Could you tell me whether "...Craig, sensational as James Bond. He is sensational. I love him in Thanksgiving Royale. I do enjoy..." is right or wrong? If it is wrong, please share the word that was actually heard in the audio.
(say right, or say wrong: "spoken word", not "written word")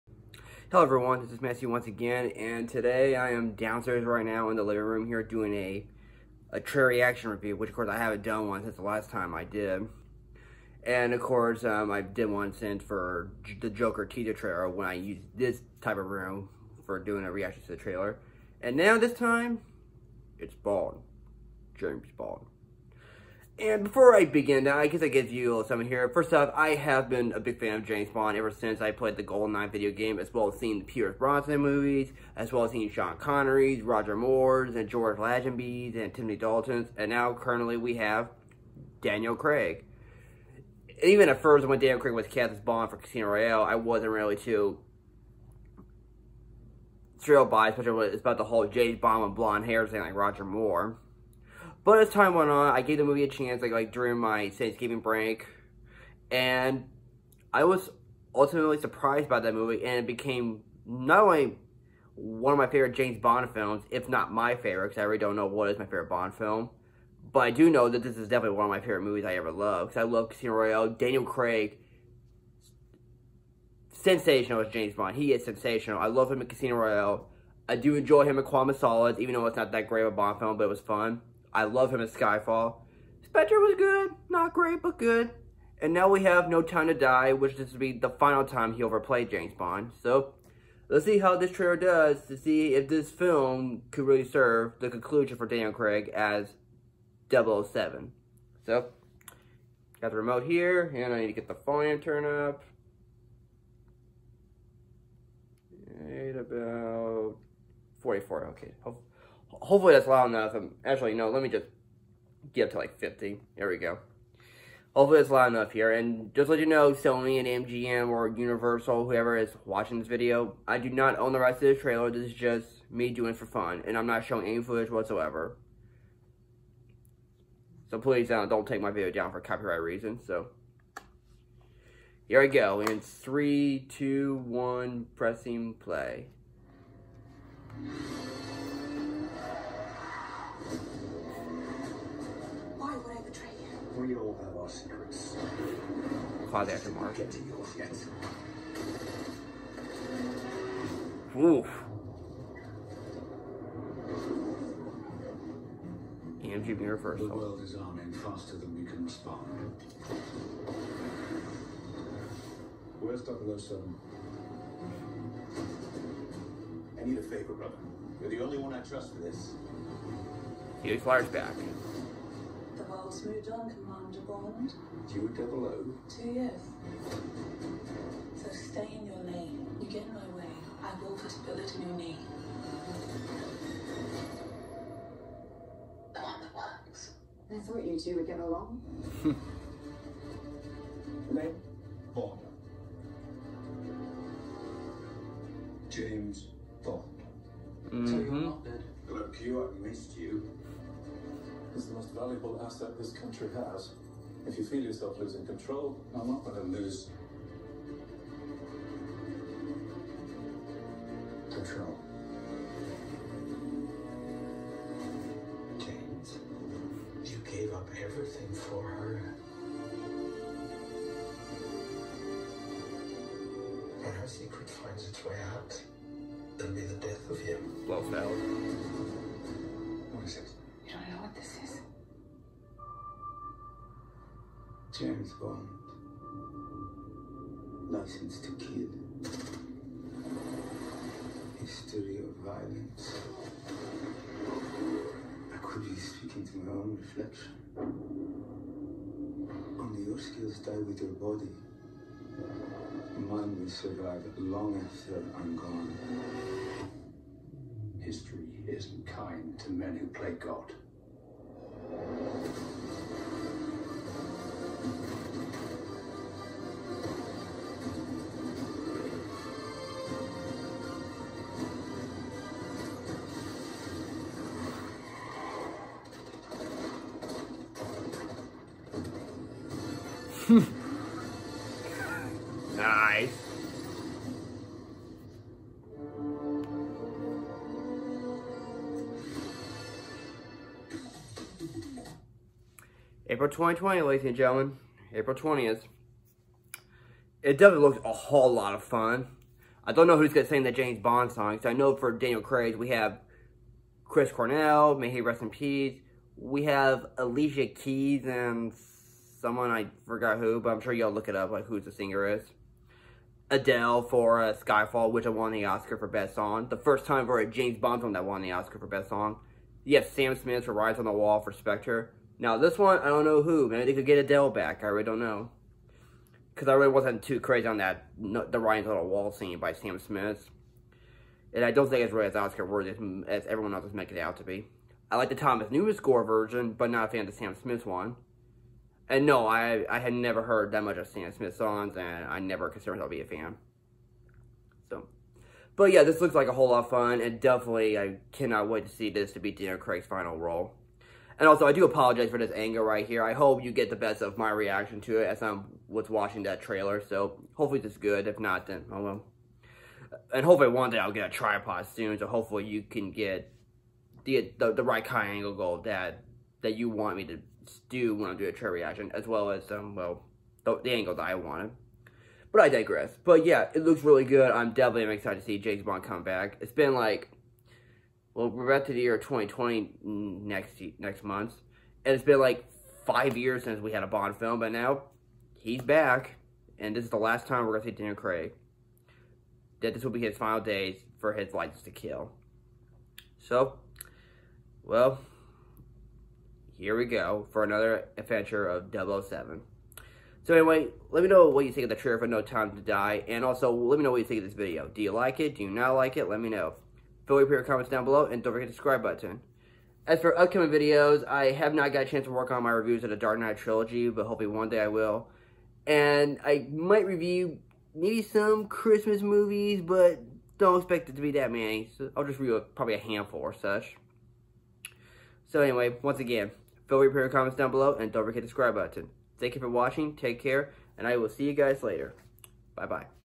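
wrong: "Casino", not "Thanksgiving".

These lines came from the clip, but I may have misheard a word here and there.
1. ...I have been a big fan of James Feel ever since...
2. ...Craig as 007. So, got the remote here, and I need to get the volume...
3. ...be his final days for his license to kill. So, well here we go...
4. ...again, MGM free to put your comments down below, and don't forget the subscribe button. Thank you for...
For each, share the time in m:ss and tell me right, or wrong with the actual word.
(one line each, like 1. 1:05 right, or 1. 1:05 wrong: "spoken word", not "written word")
1. 0:26 wrong: "Bond", not "Feel"
2. 1:35 right
3. 6:30 right
4. 7:06 wrong: "Feel", not "MGM".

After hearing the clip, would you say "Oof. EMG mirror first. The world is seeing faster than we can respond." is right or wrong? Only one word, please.
wrong.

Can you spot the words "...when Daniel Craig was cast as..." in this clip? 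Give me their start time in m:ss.
0:41.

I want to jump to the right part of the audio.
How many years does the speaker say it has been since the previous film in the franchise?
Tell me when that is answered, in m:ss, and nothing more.
6:23.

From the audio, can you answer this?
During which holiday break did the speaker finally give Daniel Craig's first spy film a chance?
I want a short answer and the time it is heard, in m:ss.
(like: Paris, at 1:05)
Thanksgiving, at 0:54.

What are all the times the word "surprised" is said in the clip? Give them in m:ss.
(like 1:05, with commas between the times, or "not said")
0:58.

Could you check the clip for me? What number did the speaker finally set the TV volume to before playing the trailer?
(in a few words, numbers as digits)
50.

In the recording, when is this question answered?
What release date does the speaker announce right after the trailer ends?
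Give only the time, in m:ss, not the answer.
4:55.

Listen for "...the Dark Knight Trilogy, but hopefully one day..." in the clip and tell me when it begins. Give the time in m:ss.
6:53.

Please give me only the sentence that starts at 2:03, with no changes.
And I'm not showing any footage whatsoever.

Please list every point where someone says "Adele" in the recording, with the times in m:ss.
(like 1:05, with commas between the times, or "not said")
5:13, 5:24.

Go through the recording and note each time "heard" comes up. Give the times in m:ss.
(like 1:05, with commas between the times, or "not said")
5:40.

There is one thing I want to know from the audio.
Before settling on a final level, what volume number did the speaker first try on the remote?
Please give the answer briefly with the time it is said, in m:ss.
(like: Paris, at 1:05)
44, at 1:48.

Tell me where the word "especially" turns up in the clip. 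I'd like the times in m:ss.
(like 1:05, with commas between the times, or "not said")
0:47.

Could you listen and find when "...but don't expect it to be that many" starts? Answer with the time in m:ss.
6:59.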